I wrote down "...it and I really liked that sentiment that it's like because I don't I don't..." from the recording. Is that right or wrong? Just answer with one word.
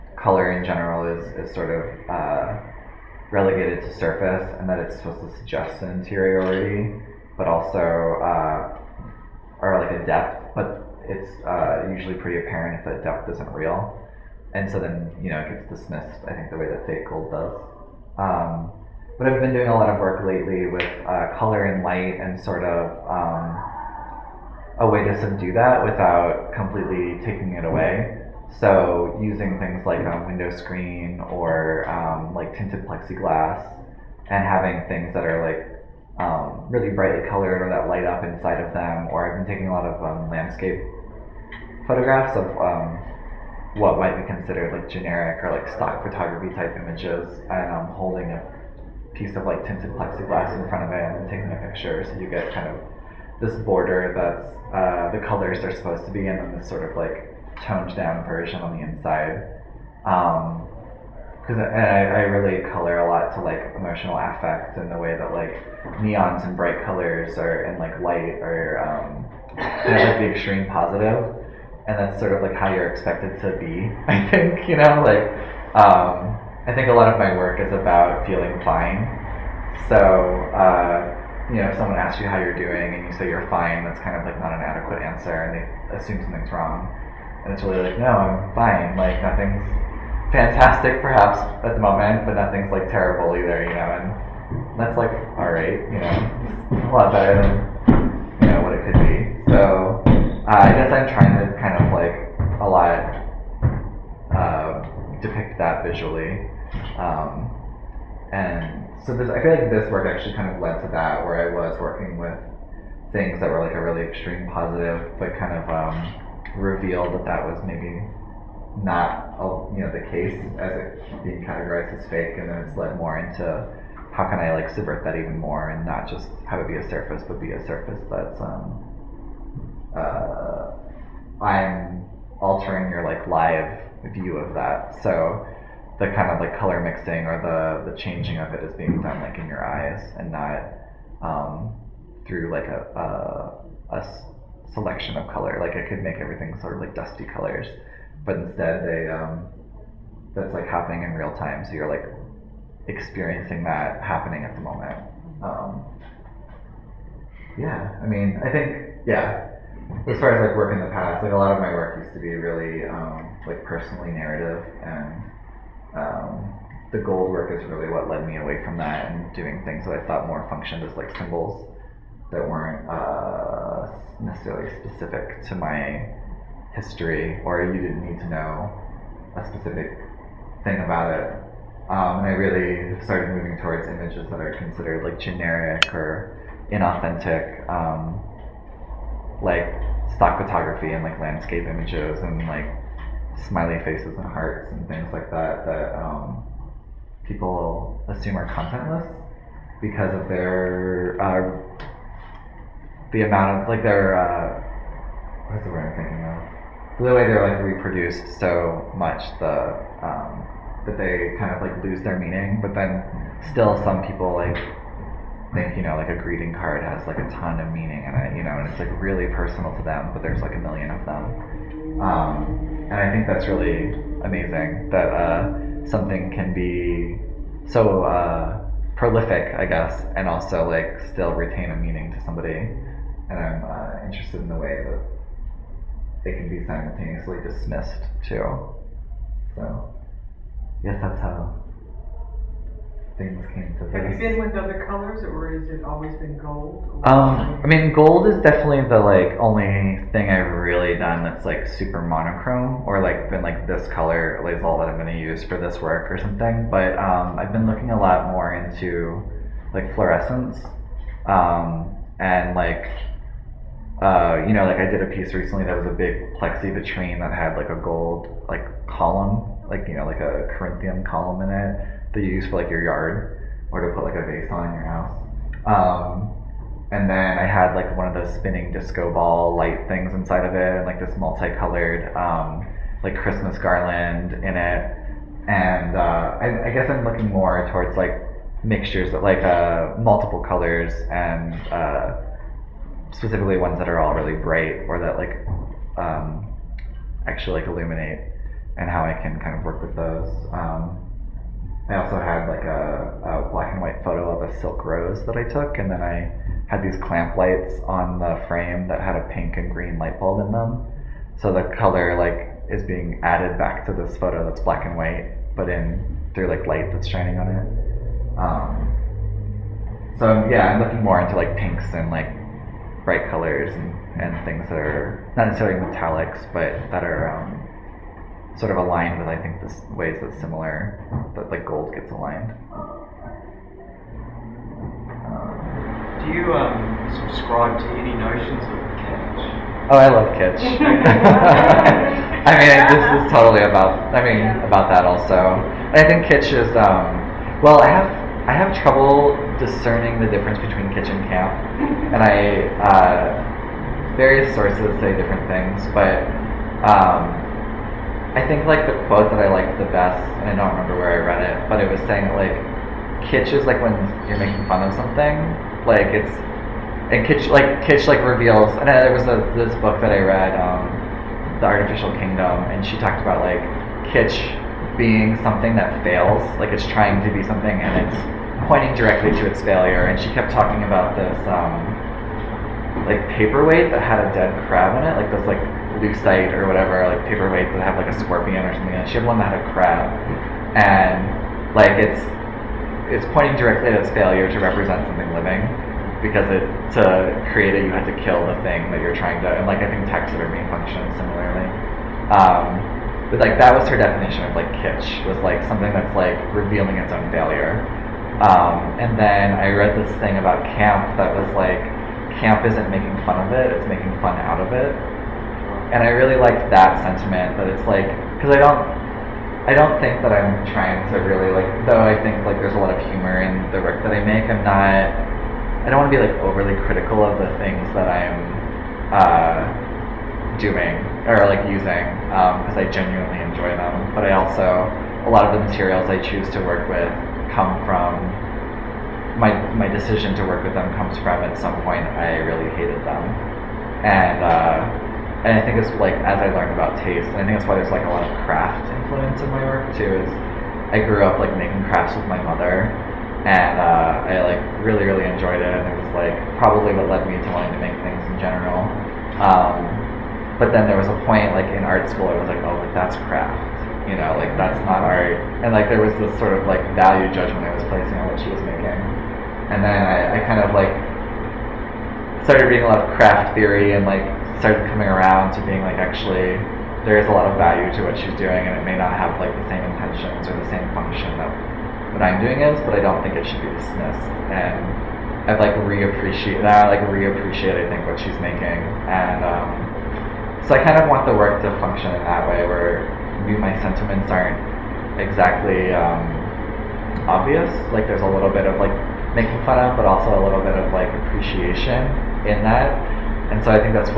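right.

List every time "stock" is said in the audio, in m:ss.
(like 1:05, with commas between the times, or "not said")
0:45, 3:10.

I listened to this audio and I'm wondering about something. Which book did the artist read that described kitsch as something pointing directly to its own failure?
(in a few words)
The Artificial Kingdom.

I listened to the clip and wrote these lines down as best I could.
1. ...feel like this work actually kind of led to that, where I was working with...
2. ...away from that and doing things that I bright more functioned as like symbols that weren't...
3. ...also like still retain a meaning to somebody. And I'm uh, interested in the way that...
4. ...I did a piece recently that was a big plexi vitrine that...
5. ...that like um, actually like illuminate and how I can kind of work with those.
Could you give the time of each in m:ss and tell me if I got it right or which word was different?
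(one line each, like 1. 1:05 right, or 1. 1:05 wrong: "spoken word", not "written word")
1. 1:49 right
2. 2:48 wrong: "thought", not "bright"
3. 3:50 right
4. 4:24 right
5. 4:54 right.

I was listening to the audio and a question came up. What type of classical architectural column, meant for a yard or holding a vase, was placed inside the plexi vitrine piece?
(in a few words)
Corinthian.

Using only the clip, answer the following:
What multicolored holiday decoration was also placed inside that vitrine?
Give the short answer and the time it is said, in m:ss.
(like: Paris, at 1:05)
Christmas garland, at 4:43.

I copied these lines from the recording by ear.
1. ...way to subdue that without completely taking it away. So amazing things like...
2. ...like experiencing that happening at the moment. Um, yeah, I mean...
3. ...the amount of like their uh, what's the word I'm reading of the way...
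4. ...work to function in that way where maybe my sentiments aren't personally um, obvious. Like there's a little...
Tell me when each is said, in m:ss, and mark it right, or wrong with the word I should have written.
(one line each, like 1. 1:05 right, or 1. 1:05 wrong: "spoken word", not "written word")
1. 0:24 wrong: "using", not "amazing"
2. 2:31 right
3. 3:23 wrong: "thinking", not "reading"
4. 8:11 wrong: "exactly", not "personally".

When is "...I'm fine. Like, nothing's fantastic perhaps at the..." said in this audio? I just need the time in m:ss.
1:28.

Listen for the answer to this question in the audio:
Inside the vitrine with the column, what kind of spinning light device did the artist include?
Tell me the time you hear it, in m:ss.
4:38.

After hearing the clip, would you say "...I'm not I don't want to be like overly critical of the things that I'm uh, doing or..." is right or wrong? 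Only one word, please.
right.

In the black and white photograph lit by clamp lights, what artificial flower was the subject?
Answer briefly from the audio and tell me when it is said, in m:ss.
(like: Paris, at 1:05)
silk rose, at 5:04.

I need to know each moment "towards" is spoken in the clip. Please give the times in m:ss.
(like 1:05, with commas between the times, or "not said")
3:03, 4:47.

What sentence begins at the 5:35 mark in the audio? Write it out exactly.
Um, Do you um, subscribe to any notions of kitsch?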